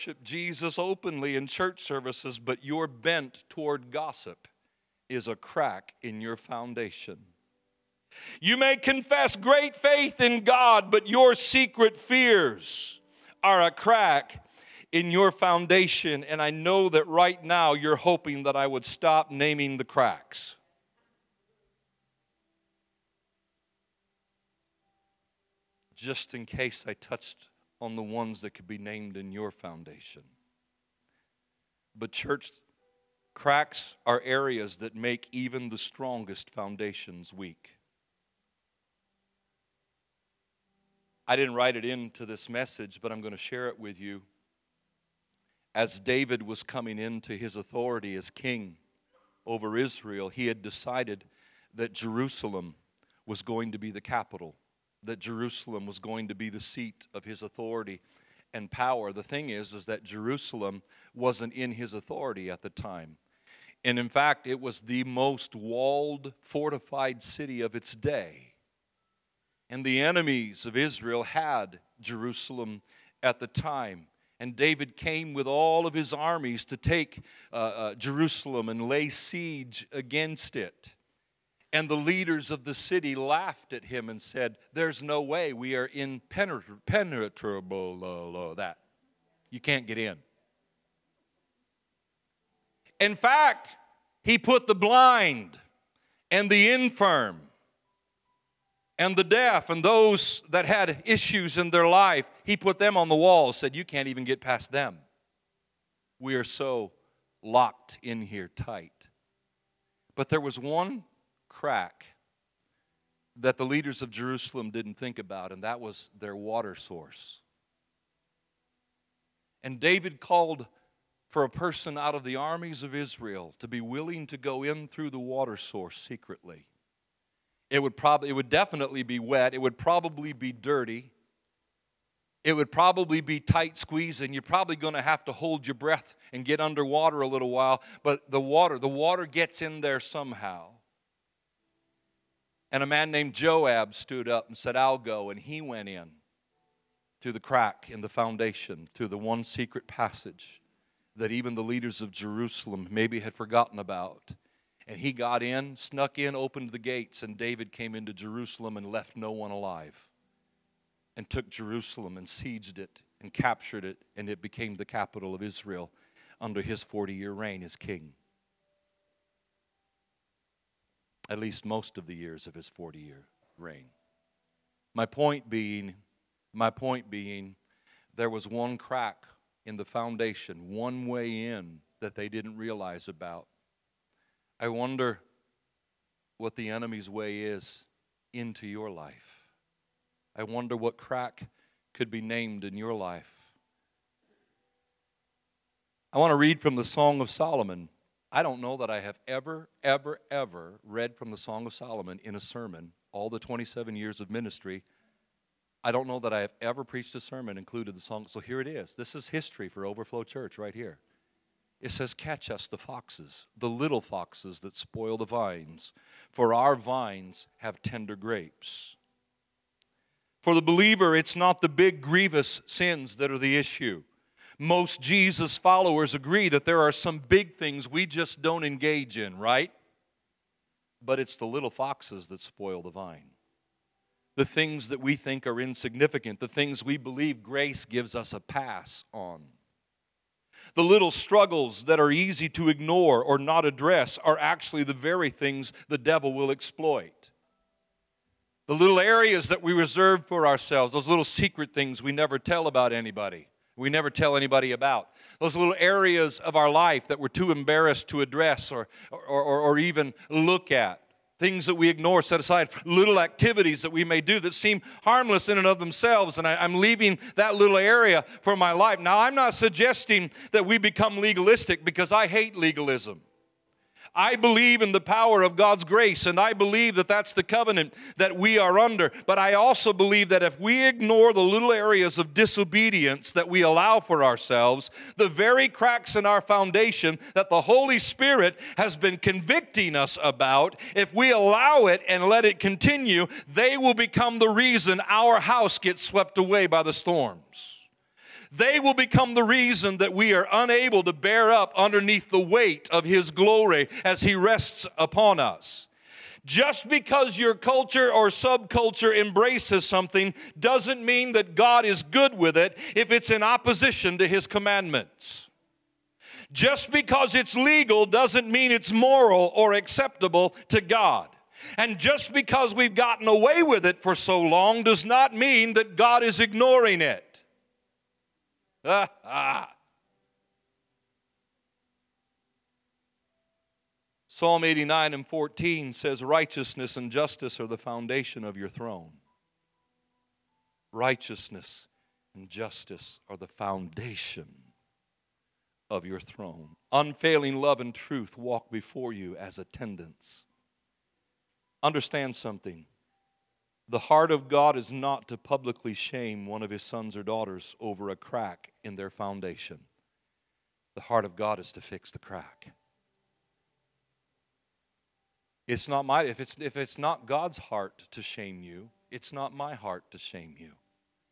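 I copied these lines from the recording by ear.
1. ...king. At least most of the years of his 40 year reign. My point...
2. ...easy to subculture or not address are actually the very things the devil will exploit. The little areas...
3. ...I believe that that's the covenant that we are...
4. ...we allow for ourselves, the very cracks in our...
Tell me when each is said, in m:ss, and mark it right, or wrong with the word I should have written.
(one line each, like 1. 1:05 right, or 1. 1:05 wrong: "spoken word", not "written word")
1. 2:47 right
2. 4:02 wrong: "ignore", not "subculture"
3. 4:36 right
4. 4:43 right.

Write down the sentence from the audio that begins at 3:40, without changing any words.
For the believer, it's not the big grievous sins that are the issue.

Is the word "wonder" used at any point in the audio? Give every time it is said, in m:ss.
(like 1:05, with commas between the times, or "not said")
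3:04, 3:10.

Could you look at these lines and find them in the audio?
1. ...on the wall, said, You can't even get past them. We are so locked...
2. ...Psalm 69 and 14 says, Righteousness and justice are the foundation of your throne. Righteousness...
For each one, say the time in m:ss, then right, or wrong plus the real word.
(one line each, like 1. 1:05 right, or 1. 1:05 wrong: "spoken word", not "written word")
1. 1:42 right
2. 5:34 wrong: "89", not "69".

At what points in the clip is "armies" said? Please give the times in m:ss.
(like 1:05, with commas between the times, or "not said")
1:16, 2:02.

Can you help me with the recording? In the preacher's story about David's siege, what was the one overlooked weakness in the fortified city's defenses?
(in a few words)
Their water source.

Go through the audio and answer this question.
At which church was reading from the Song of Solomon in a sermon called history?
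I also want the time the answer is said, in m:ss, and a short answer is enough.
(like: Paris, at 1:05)
Overflow Church, at 3:29.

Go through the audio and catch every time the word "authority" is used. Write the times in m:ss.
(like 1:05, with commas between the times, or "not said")
0:47, 0:57, 1:01.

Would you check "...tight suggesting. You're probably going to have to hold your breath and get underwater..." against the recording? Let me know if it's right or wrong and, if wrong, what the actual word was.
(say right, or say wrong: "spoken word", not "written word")
wrong: "squeezing", not "suggesting".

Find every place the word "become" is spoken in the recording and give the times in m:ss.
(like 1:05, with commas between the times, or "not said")
4:30, 4:53, 4:58.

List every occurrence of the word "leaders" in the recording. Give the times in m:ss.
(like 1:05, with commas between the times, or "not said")
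1:21, 1:53, 2:31.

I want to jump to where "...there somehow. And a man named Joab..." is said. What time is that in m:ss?
2:19.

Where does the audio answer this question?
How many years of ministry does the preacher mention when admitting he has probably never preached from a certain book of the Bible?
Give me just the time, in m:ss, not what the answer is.
3:23.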